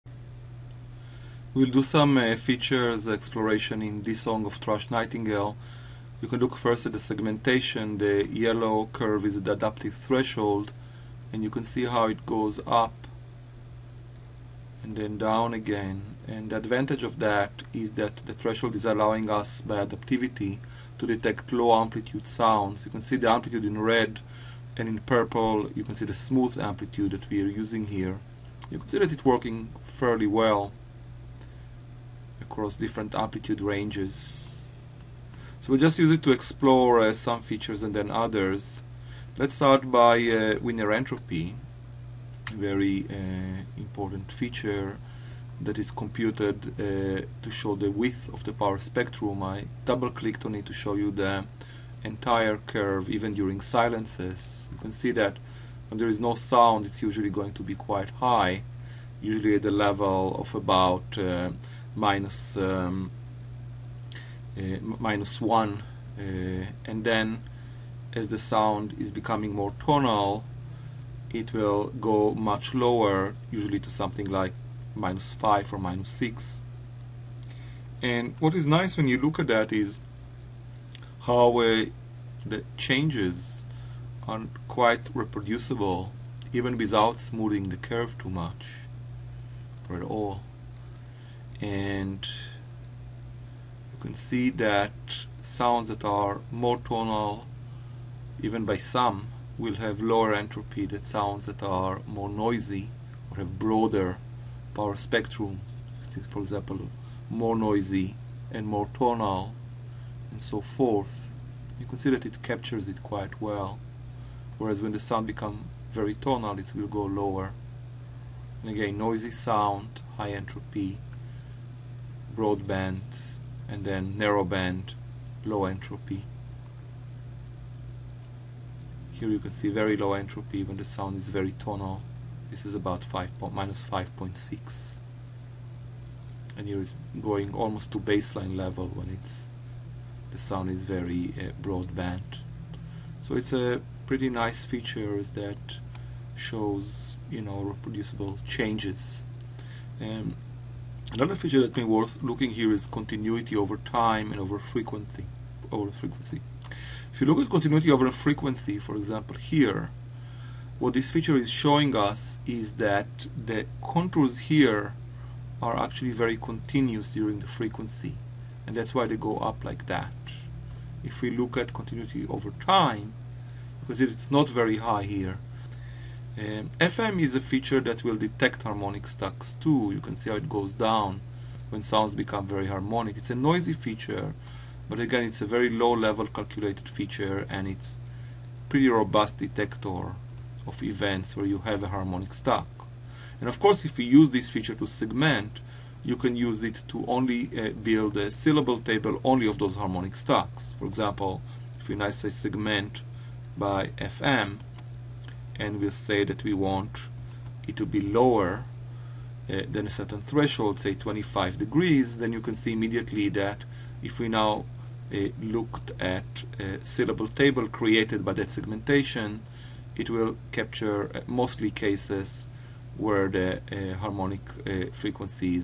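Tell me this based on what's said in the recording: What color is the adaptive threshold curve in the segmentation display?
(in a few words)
Yellow.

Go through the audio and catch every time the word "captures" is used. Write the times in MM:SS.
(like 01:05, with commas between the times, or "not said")
01:52, 03:40.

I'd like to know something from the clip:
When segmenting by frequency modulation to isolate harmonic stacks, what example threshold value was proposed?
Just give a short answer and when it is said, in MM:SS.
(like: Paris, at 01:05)
25 degrees, at 03:30.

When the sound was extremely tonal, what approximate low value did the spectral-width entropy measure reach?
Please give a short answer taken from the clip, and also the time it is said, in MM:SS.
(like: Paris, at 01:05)
-5.6, at 02:13.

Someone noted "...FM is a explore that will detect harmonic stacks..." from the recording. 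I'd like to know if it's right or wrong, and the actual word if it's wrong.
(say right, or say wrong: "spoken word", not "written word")
wrong: "feature", not "explore".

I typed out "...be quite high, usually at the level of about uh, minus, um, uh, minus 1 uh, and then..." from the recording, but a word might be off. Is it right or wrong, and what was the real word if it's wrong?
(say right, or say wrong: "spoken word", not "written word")
right.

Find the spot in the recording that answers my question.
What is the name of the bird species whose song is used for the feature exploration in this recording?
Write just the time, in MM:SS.
00:04.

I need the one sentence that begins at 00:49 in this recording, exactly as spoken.
I double clicked on it to show you the entire curve even during silences.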